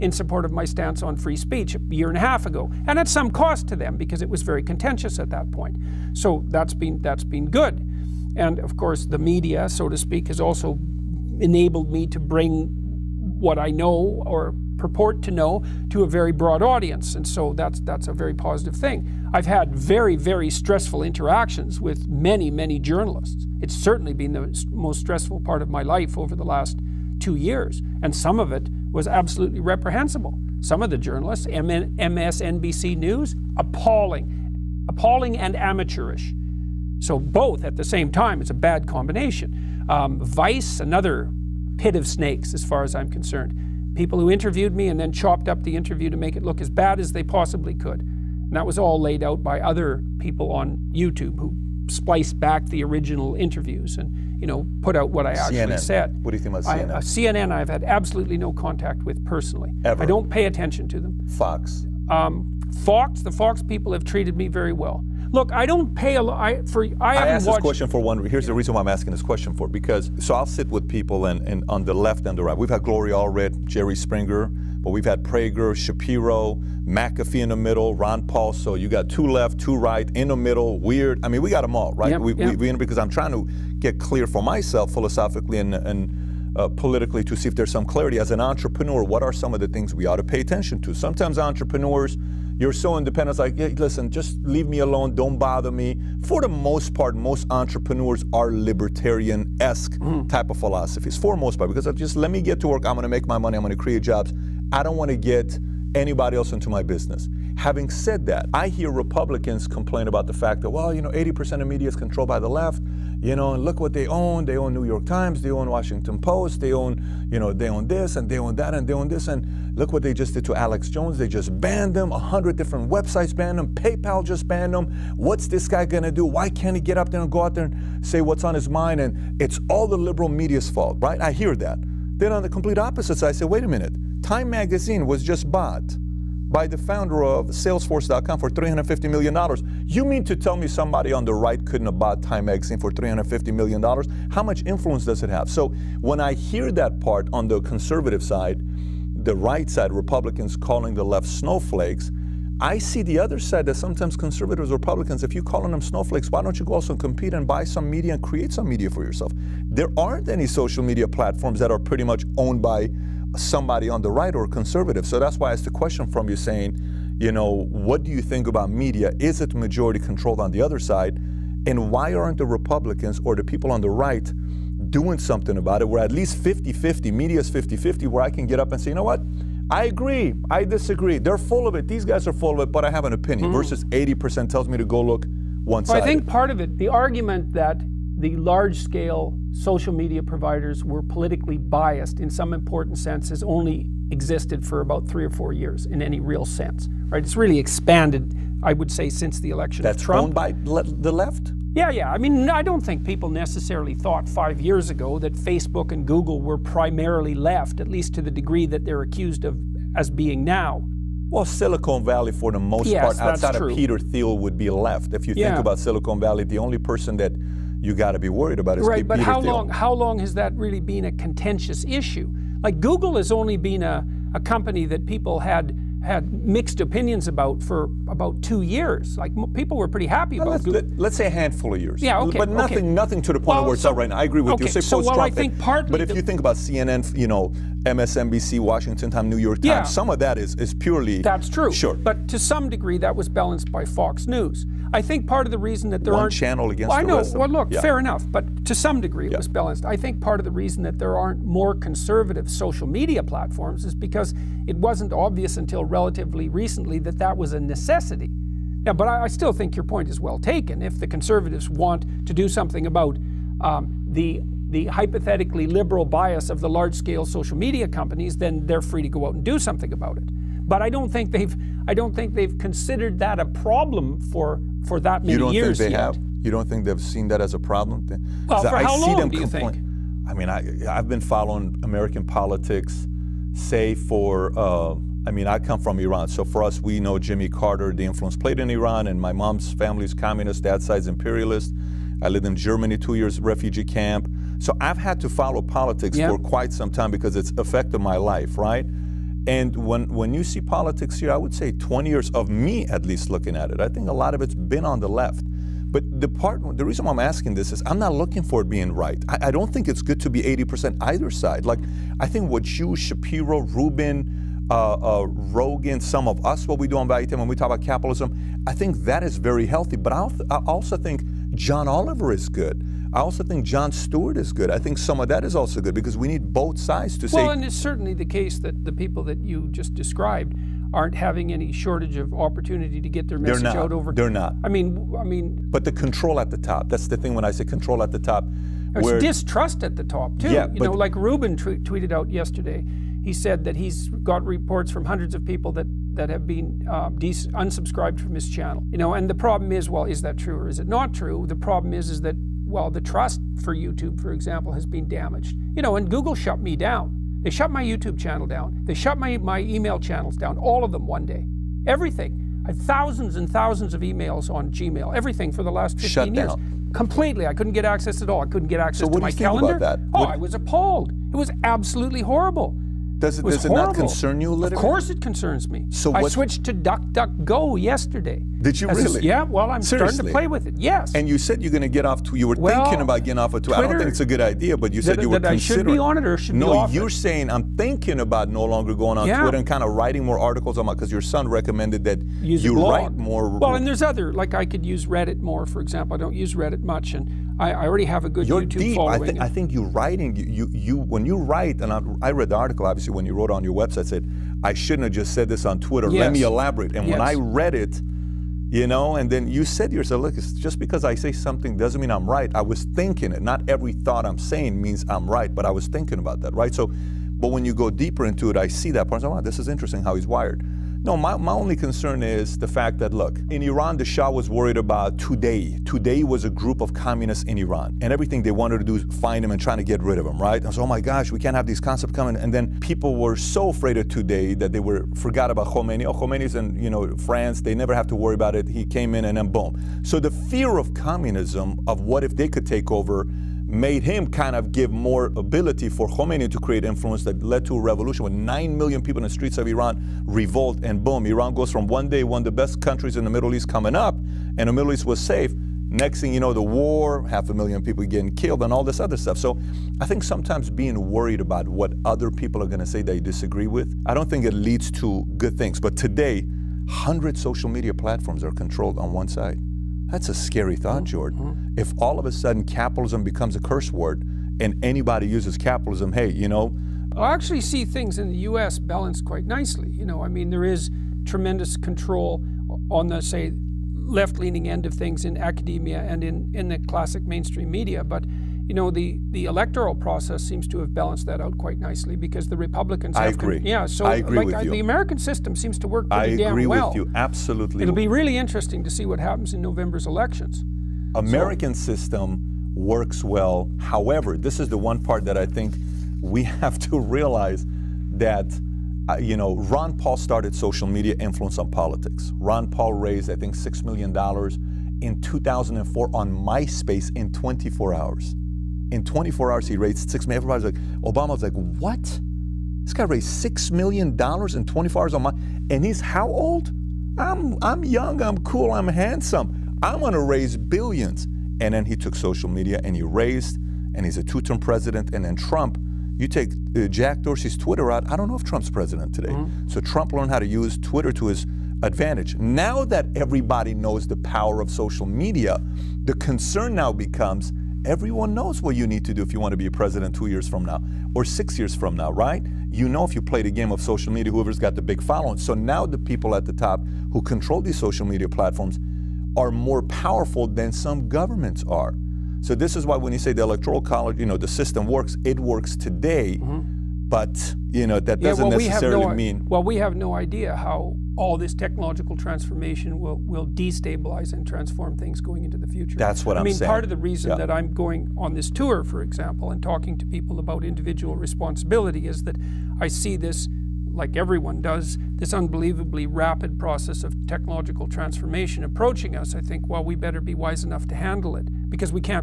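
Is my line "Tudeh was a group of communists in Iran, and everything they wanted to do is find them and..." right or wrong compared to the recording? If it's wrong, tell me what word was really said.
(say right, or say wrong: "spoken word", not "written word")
right.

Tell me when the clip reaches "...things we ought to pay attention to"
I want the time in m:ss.
1:29.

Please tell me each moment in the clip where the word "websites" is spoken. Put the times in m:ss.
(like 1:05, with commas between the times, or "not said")
2:02, 6:43.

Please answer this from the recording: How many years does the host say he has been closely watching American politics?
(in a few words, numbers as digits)
20.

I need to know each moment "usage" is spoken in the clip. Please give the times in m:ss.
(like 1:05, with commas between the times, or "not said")
not said.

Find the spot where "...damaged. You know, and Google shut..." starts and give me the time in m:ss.
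5:55.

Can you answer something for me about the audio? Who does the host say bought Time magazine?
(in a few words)
The founder of Salesforce.com.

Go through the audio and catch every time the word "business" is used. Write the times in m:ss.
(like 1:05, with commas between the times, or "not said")
1:46.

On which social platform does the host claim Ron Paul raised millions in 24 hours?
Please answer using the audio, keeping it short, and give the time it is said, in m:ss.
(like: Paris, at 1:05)
MySpace, at 8:36.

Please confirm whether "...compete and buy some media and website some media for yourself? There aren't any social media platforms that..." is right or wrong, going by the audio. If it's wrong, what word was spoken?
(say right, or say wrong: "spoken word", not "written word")
wrong: "create", not "website".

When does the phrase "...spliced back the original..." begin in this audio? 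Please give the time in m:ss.
0:51.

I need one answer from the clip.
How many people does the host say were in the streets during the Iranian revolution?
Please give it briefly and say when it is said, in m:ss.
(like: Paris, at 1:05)
9 million, at 7:28.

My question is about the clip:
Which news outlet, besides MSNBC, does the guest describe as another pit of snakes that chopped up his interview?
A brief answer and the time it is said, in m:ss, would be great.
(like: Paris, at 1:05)
Vice, at 0:40.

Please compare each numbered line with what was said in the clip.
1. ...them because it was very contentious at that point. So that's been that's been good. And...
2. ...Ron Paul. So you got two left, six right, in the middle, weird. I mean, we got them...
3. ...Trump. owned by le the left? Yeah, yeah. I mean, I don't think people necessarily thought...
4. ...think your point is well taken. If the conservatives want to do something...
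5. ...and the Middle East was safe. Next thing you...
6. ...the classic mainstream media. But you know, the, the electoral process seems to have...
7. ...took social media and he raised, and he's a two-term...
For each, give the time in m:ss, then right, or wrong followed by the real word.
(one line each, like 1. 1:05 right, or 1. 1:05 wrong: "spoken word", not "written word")
1. 0:03 right
2. 1:17 wrong: "two", not "six"
3. 3:20 right
4. 4:19 right
5. 7:34 right
6. 8:06 right
7. 8:51 right.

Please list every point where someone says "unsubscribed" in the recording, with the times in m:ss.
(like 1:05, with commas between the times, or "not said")
5:47.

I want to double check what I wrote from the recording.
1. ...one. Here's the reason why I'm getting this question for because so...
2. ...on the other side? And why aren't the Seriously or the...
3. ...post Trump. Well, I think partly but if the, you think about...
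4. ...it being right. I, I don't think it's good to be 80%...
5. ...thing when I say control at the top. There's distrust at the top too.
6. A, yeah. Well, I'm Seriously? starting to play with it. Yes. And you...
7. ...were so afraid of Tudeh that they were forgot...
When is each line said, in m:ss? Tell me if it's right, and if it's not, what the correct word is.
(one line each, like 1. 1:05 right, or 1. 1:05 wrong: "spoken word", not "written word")
1. 1:07 wrong: "asking", not "getting"
2. 2:50 wrong: "Republicans", not "Seriously"
3. 3:54 right
4. 5:08 right
5. 5:37 right
6. 6:19 right
7. 7:13 right.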